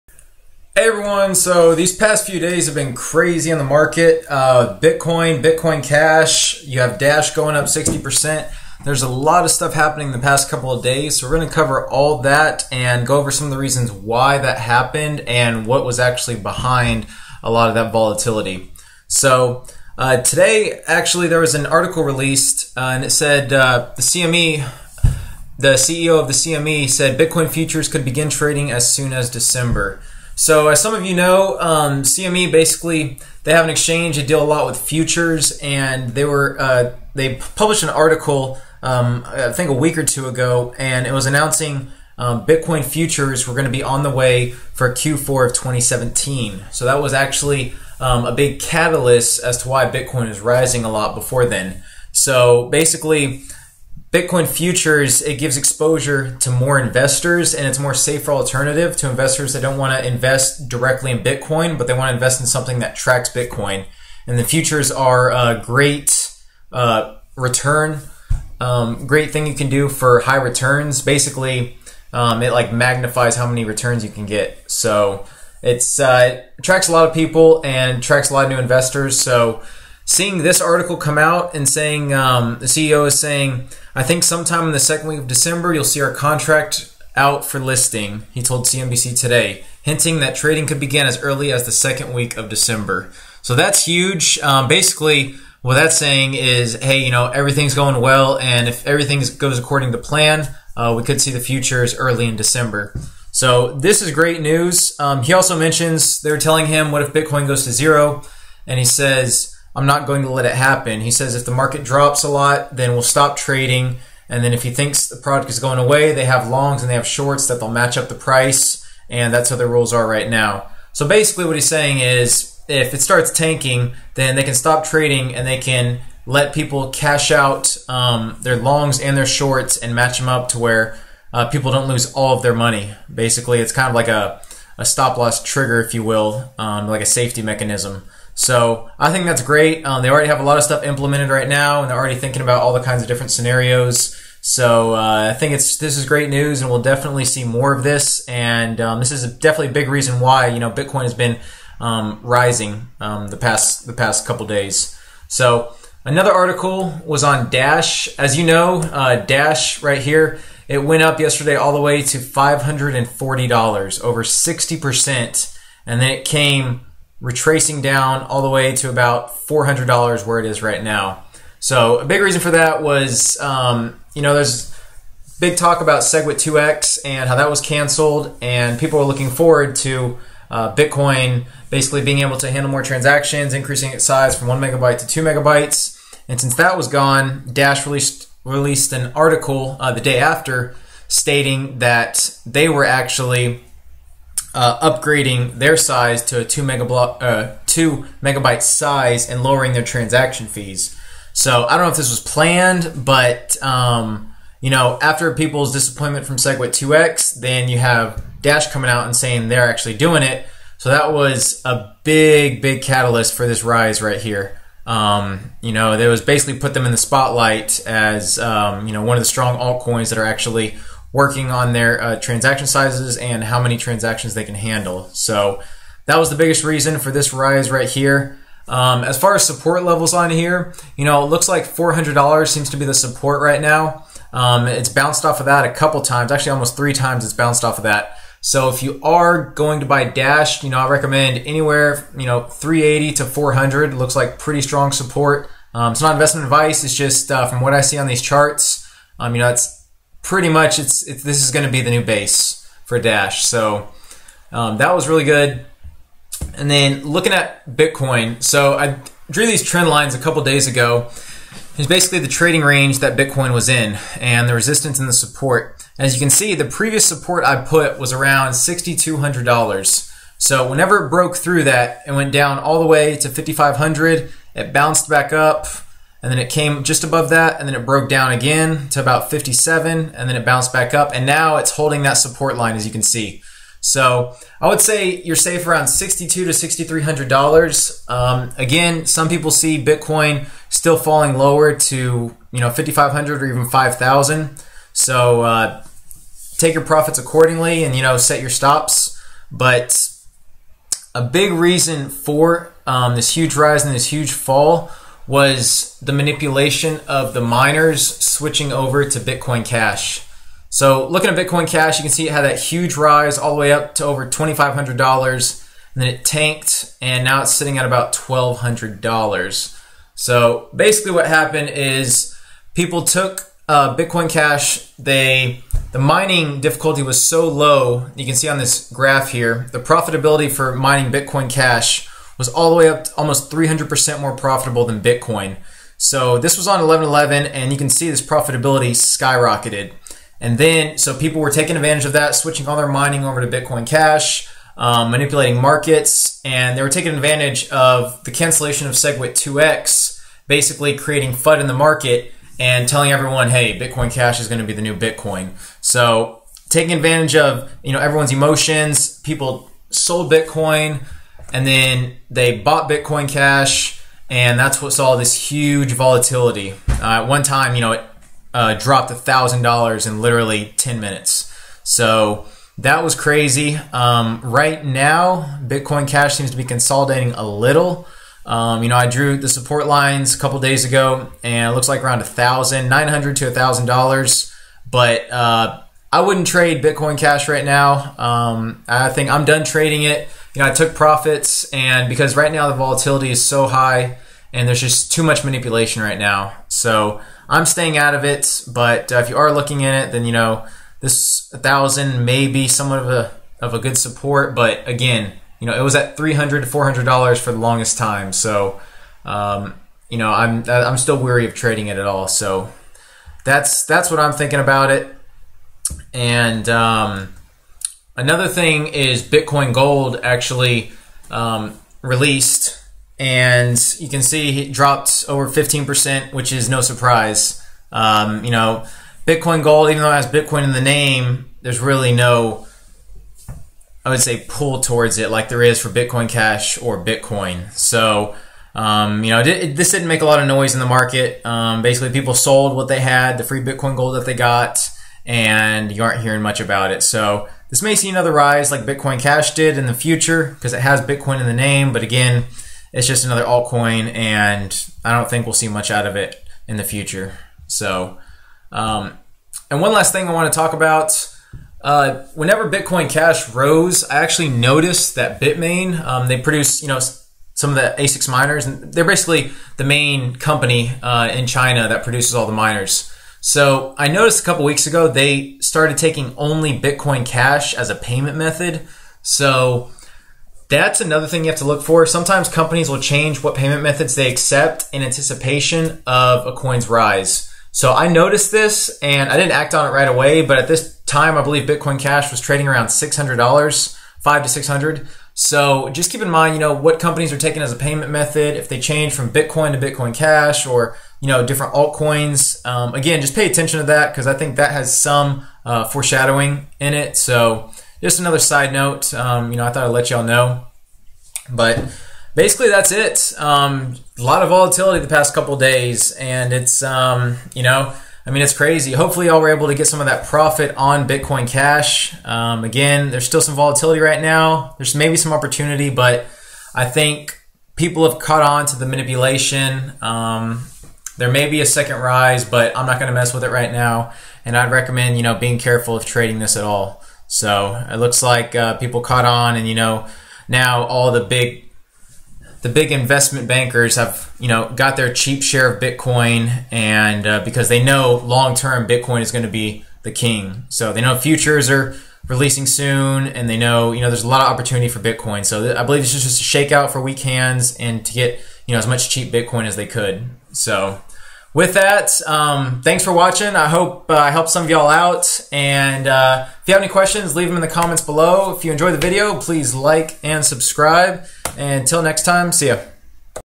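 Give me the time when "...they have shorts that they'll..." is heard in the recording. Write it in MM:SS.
01:56.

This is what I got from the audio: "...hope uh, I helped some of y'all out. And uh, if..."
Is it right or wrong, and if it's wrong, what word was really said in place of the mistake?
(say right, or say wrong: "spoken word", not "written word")
right.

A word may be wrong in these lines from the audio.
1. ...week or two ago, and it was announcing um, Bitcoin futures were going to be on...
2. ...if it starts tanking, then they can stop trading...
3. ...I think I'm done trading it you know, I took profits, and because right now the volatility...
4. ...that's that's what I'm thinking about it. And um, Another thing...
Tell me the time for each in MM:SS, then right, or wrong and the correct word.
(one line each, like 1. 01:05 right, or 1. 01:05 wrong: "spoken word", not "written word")
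1. 00:39 right
2. 02:02 right
3. 06:28 right
4. 06:53 right.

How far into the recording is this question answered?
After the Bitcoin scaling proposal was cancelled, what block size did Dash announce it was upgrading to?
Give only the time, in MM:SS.
03:17.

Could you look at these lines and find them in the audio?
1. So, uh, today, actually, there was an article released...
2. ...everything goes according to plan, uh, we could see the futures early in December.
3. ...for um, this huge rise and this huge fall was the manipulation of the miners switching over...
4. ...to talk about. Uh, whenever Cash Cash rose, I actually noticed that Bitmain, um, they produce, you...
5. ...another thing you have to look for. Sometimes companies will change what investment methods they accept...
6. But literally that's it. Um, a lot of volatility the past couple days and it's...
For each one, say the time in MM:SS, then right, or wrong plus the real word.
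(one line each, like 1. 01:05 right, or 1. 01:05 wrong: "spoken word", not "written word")
1. 00:19 right
2. 01:38 right
3. 05:02 right
4. 07:40 wrong: "Bitcoin", not "Cash"
5. 08:01 wrong: "payment", not "investment"
6. 08:31 wrong: "basically", not "literally".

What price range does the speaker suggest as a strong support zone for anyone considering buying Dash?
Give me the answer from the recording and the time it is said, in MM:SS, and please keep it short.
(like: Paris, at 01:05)
380 to 400, at 04:02.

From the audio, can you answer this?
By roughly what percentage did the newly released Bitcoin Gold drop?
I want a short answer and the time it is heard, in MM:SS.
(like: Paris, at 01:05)
15%, at 07:05.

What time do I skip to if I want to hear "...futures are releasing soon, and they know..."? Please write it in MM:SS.
09:11.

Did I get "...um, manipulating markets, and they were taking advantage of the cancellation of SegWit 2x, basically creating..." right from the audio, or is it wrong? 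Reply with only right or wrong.
right.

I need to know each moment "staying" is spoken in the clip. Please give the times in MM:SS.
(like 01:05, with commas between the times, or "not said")
06:37.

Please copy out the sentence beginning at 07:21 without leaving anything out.
Um, basically, people sold what they had, the free Bitcoin Gold that they got, and you aren't hearing much about it.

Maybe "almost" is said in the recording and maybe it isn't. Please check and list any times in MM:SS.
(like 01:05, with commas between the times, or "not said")
03:56, 05:33.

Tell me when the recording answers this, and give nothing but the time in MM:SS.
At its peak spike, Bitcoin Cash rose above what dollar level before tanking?
05:14.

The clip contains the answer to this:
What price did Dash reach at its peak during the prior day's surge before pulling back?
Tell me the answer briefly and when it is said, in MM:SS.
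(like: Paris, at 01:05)
$540, at 02:42.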